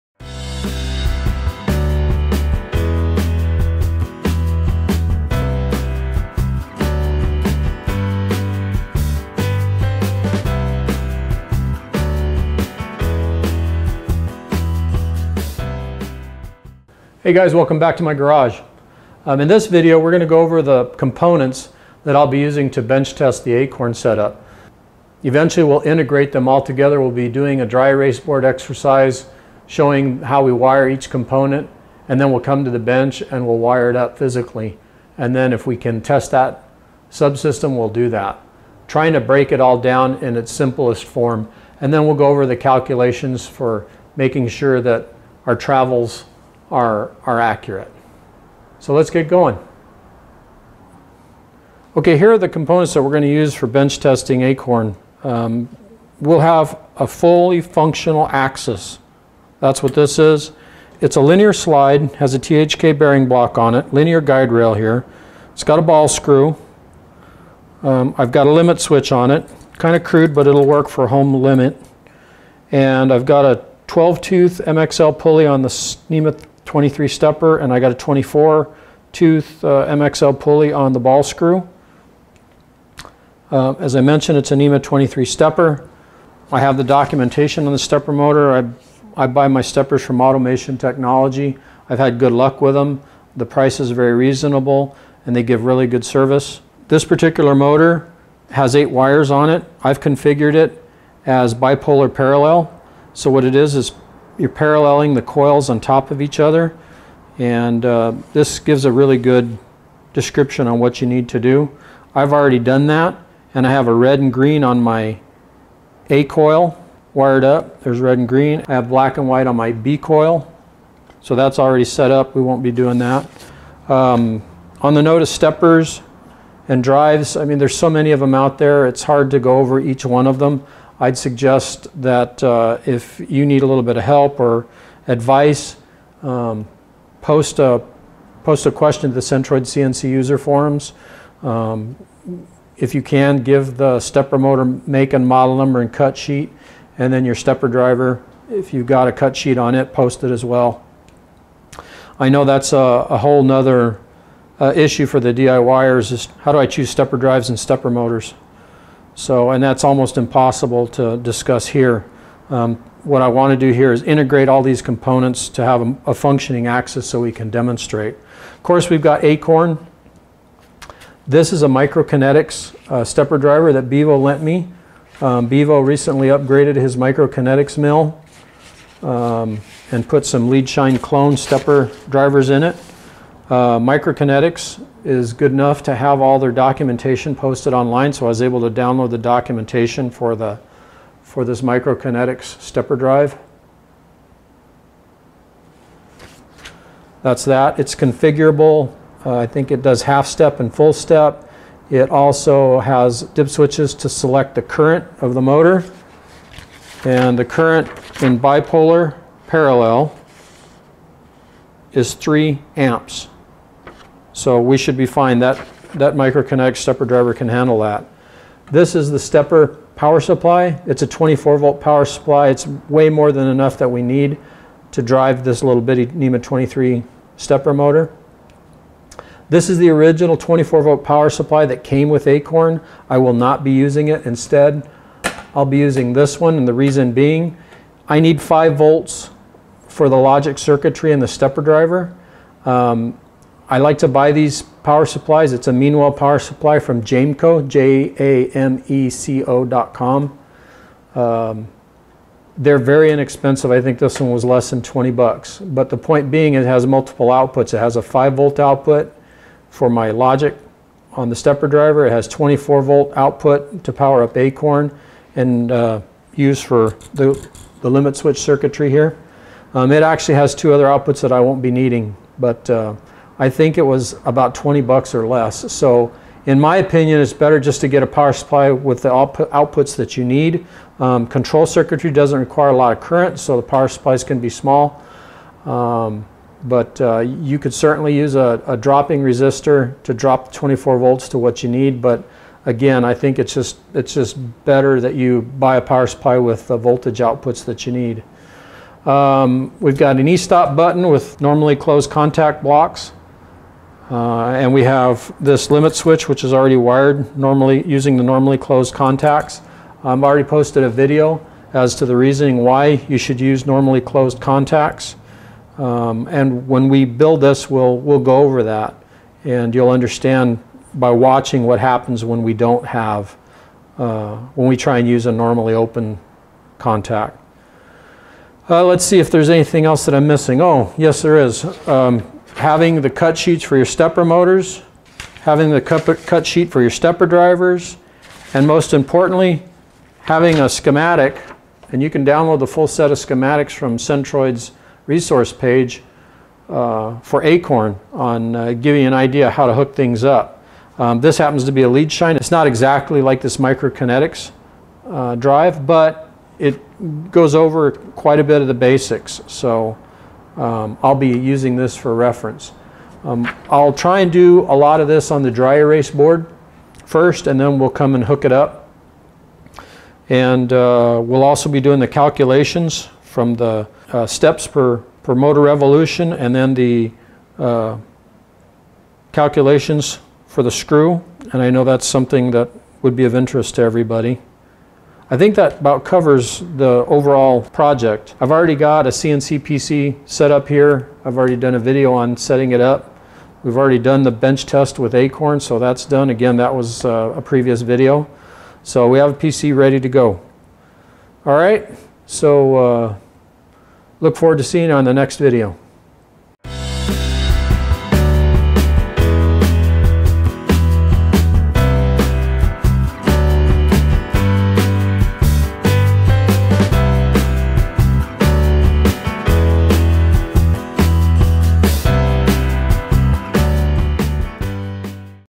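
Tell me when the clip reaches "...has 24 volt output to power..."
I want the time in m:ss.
4:22.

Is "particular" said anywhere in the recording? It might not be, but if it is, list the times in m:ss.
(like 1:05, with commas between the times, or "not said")
1:37.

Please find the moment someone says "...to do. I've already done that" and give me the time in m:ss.
1:51.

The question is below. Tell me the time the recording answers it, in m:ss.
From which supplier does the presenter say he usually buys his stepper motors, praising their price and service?
1:30.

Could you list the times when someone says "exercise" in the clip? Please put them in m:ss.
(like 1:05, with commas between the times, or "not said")
0:28.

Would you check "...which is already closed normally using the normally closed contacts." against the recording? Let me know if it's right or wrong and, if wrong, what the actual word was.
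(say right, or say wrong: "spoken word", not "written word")
wrong: "wired", not "closed".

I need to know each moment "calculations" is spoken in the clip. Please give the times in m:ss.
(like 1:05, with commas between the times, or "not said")
0:42, 6:12, 6:19.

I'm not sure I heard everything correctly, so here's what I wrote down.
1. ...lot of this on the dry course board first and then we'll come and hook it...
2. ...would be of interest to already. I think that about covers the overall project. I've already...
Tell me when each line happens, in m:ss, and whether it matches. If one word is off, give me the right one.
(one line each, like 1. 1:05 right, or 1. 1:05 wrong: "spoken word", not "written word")
1. 6:04 wrong: "erase", not "course"
2. 6:23 wrong: "everybody", not "already".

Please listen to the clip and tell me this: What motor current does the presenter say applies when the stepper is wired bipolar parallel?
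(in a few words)
3 amps.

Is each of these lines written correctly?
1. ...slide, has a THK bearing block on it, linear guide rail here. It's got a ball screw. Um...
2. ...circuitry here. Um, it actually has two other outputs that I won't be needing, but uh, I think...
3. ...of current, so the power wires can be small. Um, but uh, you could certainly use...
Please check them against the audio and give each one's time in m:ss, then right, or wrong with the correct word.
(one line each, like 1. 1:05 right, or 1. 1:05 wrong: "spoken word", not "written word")
1. 1:01 right
2. 4:28 right
3. 4:42 wrong: "supplies", not "wires".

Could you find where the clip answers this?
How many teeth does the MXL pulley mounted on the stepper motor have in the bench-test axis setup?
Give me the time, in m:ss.
1:13.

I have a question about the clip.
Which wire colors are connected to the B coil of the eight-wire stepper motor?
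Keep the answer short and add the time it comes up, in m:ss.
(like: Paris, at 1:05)
Black and white, at 1:58.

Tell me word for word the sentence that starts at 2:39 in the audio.
So, and that's almost impossible to discuss here.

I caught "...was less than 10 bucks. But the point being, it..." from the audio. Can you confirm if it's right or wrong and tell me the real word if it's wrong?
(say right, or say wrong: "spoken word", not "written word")
wrong: "20", not "10".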